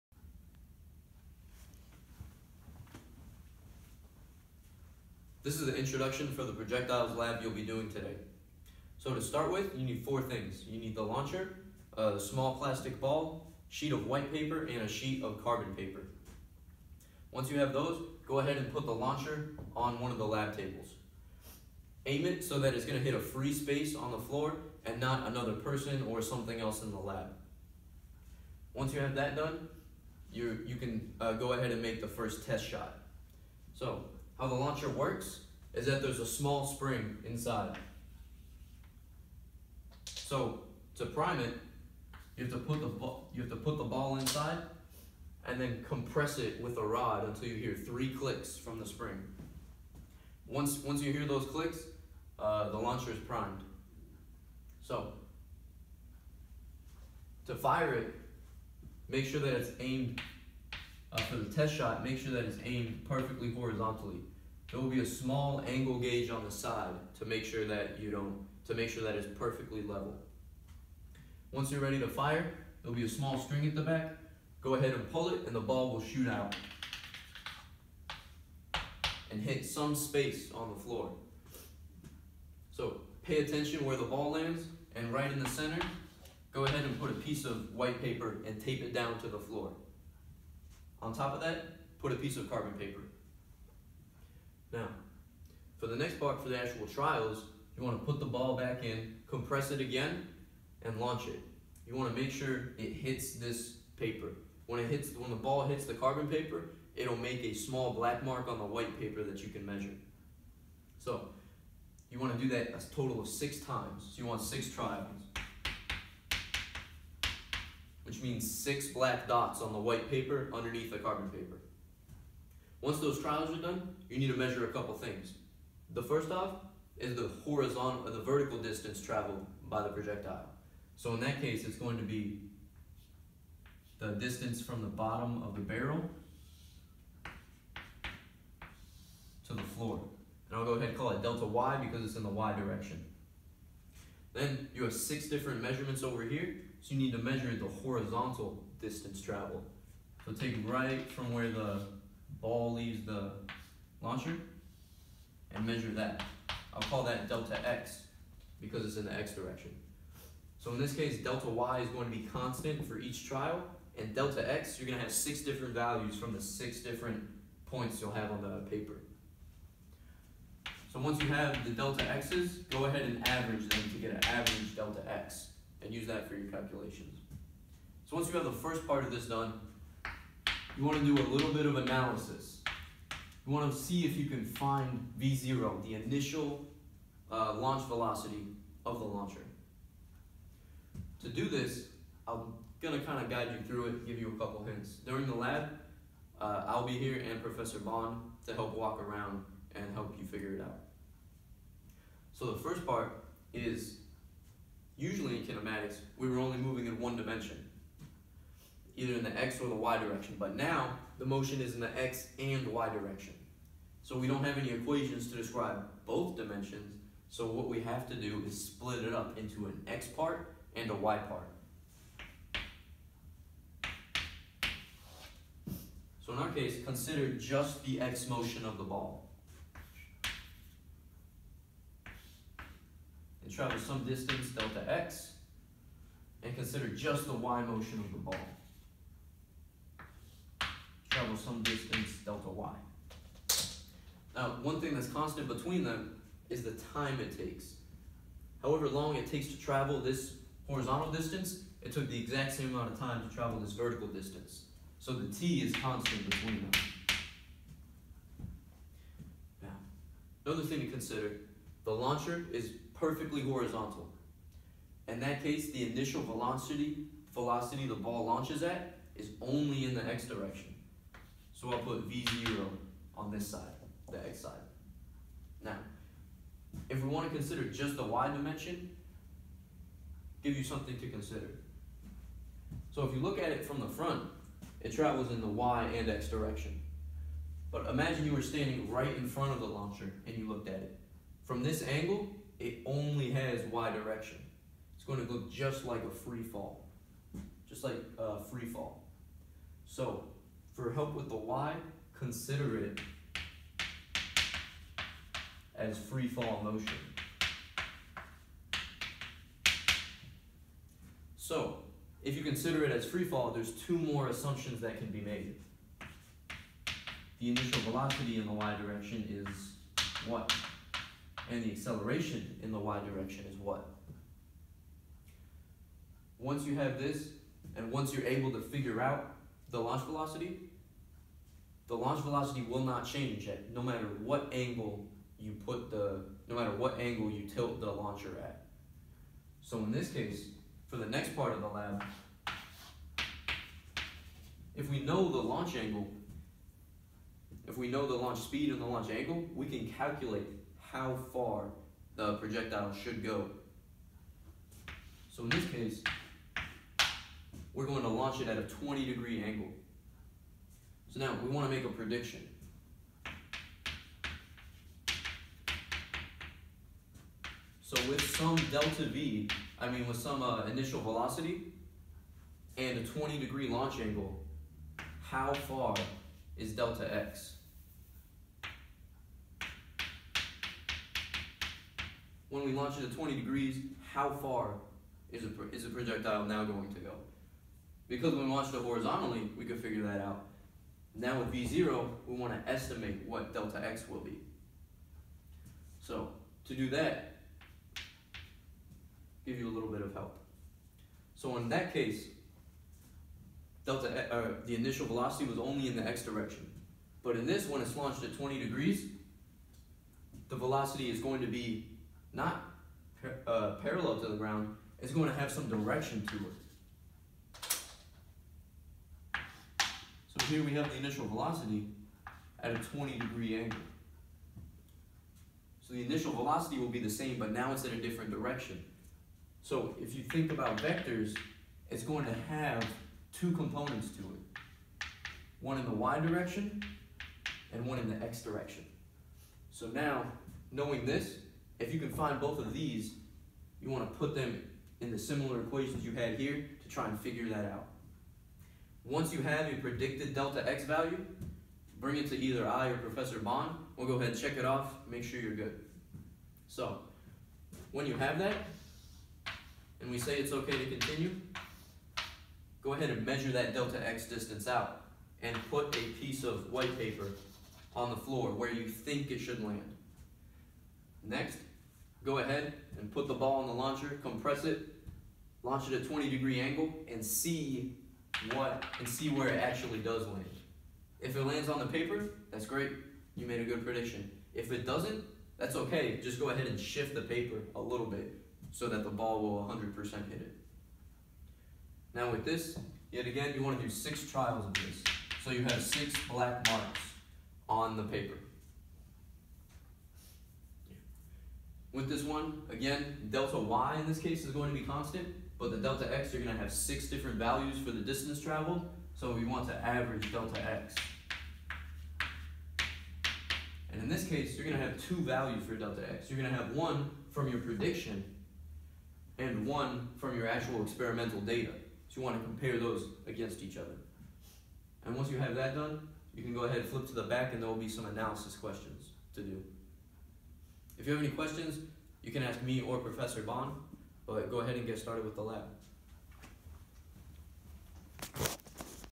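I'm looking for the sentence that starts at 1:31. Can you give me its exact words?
On top of that, put a piece of carbon paper.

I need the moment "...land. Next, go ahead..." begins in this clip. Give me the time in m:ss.
7:49.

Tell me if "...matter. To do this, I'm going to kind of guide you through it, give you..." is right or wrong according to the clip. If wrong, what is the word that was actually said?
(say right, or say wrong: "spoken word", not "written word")
wrong: "launcher", not "matter".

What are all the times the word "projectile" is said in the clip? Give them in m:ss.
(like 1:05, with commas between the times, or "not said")
0:06, 2:09, 5:52, 6:25.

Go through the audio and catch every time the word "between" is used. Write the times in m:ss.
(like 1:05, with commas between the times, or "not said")
4:05, 4:16.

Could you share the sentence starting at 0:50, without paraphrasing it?
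Once once you hear those clicks, uh, the launcher is primed.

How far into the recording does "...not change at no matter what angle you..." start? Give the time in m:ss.
5:32.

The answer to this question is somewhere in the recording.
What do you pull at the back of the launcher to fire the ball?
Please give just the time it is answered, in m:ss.
1:13.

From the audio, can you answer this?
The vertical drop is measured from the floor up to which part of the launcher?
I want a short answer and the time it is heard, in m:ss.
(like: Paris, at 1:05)
bottom of the barrel, at 2:14.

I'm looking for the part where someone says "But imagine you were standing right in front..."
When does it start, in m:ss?
4:47.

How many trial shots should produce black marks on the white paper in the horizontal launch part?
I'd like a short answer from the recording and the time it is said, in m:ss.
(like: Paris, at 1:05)
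6, at 1:53.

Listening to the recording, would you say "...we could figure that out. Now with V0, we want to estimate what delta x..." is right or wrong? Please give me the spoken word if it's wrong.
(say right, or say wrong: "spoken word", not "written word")
right.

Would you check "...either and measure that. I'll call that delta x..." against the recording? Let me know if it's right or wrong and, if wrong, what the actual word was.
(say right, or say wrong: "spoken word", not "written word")
wrong: "launcher", not "either".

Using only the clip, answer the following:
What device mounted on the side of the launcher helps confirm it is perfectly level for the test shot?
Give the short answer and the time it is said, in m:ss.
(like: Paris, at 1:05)
angle gauge, at 1:05.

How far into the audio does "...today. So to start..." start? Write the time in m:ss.
0:07.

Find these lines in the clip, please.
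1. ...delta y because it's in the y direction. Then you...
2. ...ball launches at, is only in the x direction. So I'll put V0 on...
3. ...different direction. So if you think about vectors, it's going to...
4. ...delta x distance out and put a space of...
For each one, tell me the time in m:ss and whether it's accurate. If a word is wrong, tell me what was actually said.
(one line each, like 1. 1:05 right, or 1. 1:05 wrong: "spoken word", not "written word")
1. 2:21 right
2. 4:27 right
3. 7:08 right
4. 7:43 wrong: "piece", not "space".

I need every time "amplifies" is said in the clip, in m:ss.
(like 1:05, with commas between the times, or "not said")
not said.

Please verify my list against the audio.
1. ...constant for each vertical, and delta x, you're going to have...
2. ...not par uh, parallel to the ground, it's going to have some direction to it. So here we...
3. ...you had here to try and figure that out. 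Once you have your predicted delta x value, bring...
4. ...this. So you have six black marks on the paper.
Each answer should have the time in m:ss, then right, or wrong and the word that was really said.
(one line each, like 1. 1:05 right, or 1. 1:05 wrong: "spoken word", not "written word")
1. 2:42 wrong: "trial", not "vertical"
2. 6:52 right
3. 7:26 right
4. 8:14 right.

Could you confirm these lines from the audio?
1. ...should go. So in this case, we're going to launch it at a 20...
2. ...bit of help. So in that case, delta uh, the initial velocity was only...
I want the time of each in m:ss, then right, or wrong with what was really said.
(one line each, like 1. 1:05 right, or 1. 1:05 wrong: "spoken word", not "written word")
1. 5:52 right
2. 6:39 right.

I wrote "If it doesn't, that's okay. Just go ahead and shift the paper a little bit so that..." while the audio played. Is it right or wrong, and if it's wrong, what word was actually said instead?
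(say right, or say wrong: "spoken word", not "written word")
right.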